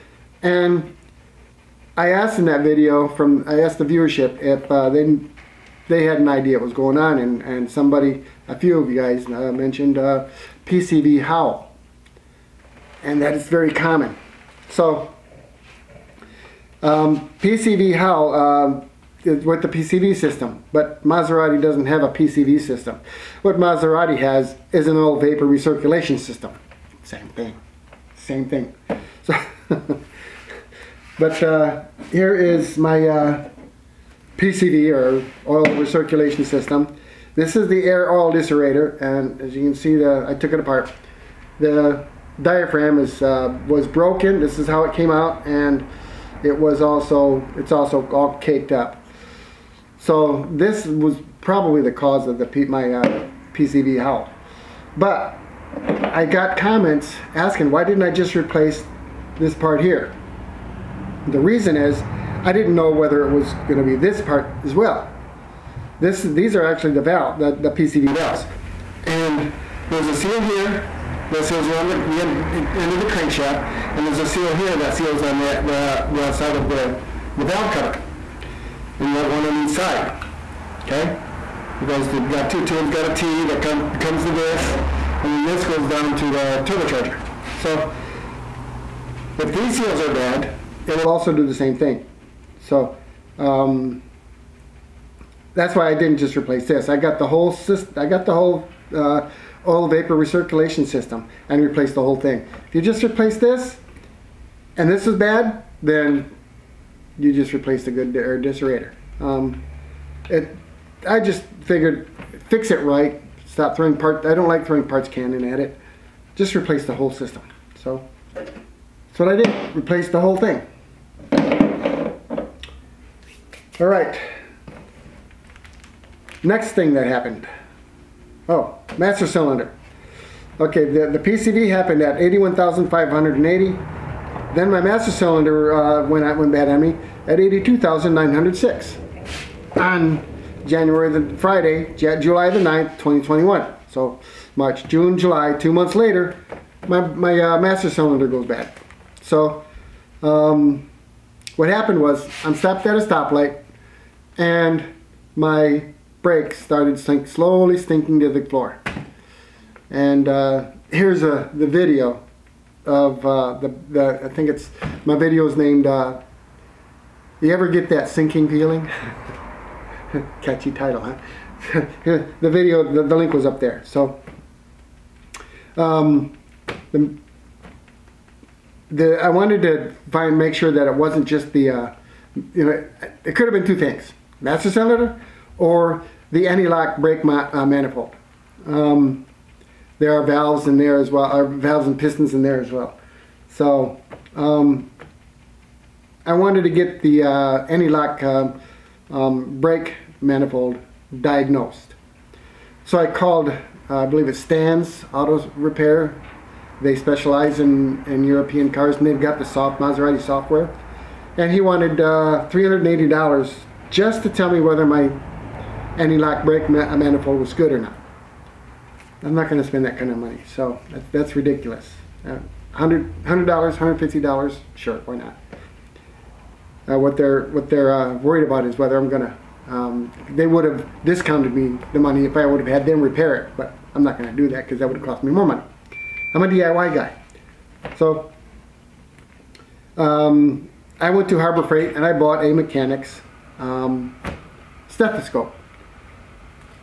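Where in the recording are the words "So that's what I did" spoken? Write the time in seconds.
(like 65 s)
117 s.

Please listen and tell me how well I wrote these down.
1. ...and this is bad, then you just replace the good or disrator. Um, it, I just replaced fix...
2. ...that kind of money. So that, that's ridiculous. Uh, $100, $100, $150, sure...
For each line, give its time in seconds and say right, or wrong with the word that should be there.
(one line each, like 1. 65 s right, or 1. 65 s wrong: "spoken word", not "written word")
1. 104 s wrong: "figured", not "replaced"
2. 219 s right.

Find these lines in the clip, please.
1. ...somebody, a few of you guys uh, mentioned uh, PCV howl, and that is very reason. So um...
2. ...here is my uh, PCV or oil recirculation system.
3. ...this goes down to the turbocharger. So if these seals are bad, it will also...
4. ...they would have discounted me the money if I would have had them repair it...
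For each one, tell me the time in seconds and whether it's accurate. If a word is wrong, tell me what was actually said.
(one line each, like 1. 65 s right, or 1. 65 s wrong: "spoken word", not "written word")
1. 7 s wrong: "common", not "reason"
2. 32 s right
3. 85 s right
4. 230 s right.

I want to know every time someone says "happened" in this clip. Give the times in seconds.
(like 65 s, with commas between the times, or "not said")
127 s, 131 s, 151 s.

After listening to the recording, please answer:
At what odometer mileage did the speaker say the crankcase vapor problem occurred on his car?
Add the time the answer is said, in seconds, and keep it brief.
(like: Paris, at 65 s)
81,580, at 132 s.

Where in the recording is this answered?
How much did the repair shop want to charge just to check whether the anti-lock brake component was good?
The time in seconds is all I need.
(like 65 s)
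212 s.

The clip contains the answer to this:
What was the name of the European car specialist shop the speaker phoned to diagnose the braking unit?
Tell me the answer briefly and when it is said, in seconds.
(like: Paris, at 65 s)
Stans Auto Repair, at 204 s.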